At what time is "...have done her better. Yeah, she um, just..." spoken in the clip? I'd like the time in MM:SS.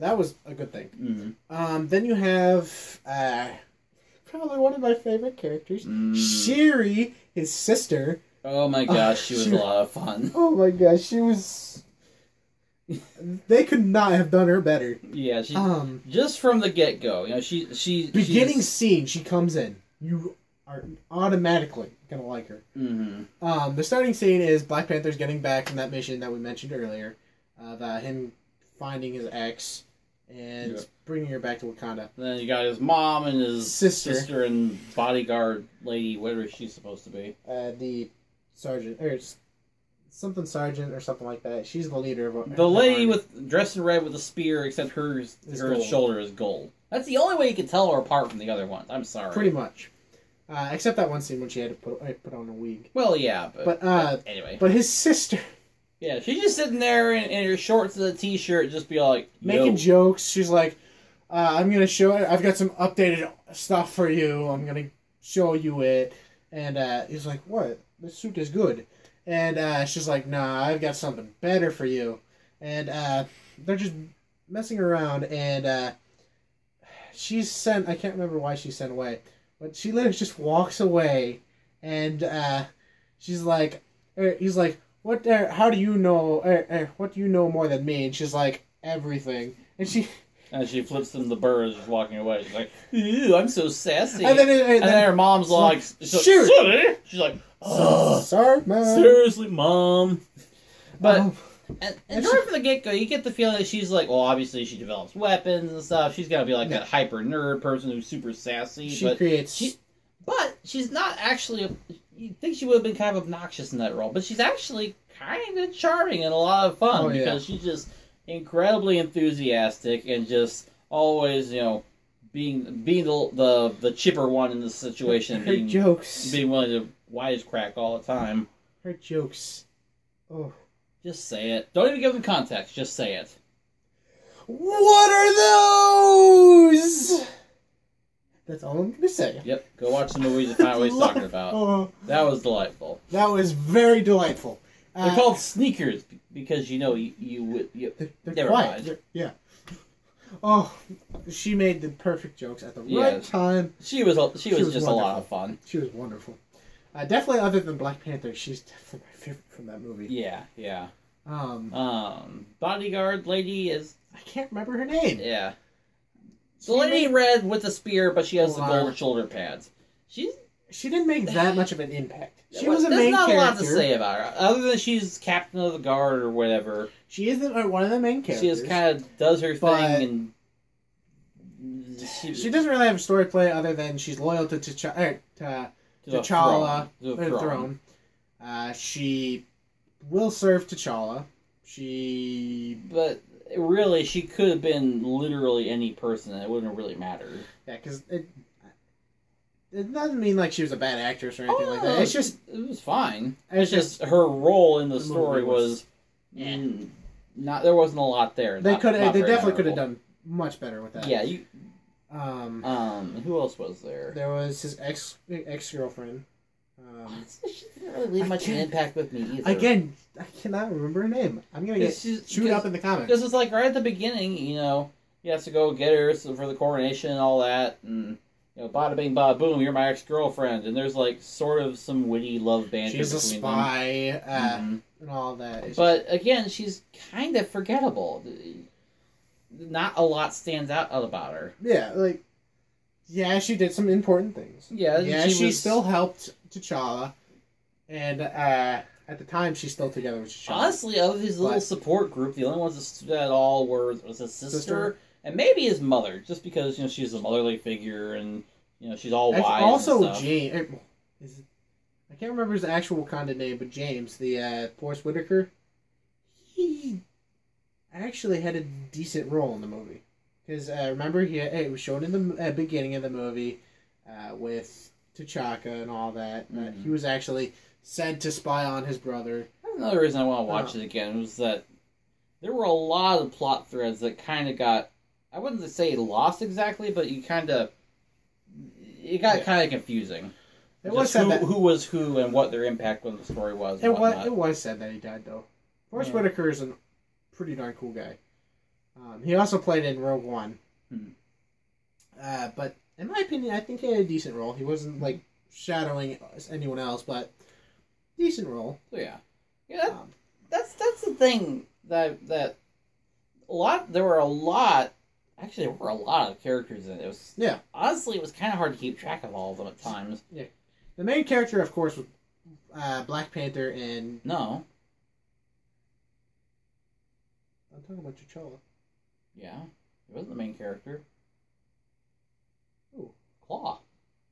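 00:14.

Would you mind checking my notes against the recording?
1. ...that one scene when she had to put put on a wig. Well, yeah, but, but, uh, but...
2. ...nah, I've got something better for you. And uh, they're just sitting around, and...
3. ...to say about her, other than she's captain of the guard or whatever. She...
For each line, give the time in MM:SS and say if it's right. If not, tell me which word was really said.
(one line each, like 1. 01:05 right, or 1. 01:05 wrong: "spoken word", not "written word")
1. 00:50 right
2. 01:10 wrong: "messing", not "sitting"
3. 02:53 right.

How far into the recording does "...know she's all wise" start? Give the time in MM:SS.
04:18.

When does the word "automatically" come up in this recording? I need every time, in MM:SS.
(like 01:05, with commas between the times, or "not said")
00:21.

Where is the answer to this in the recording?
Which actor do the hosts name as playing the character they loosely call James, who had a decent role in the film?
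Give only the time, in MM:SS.
04:24.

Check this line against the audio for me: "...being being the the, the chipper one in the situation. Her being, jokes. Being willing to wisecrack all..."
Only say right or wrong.
right.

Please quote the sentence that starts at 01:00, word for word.
She's like, uh, "I'm gonna show.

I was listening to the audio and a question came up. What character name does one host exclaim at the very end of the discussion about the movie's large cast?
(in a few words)
Claw.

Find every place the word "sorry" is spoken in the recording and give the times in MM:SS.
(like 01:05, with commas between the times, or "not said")
00:49, 01:38.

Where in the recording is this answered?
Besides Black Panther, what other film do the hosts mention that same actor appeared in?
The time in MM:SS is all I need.
05:00.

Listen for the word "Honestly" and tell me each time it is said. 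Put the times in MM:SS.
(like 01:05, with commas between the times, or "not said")
04:10, 05:17.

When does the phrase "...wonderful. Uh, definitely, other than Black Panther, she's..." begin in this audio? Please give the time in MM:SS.
02:35.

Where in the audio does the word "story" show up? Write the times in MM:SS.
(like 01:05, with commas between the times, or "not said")
03:02, 03:25, 04:53.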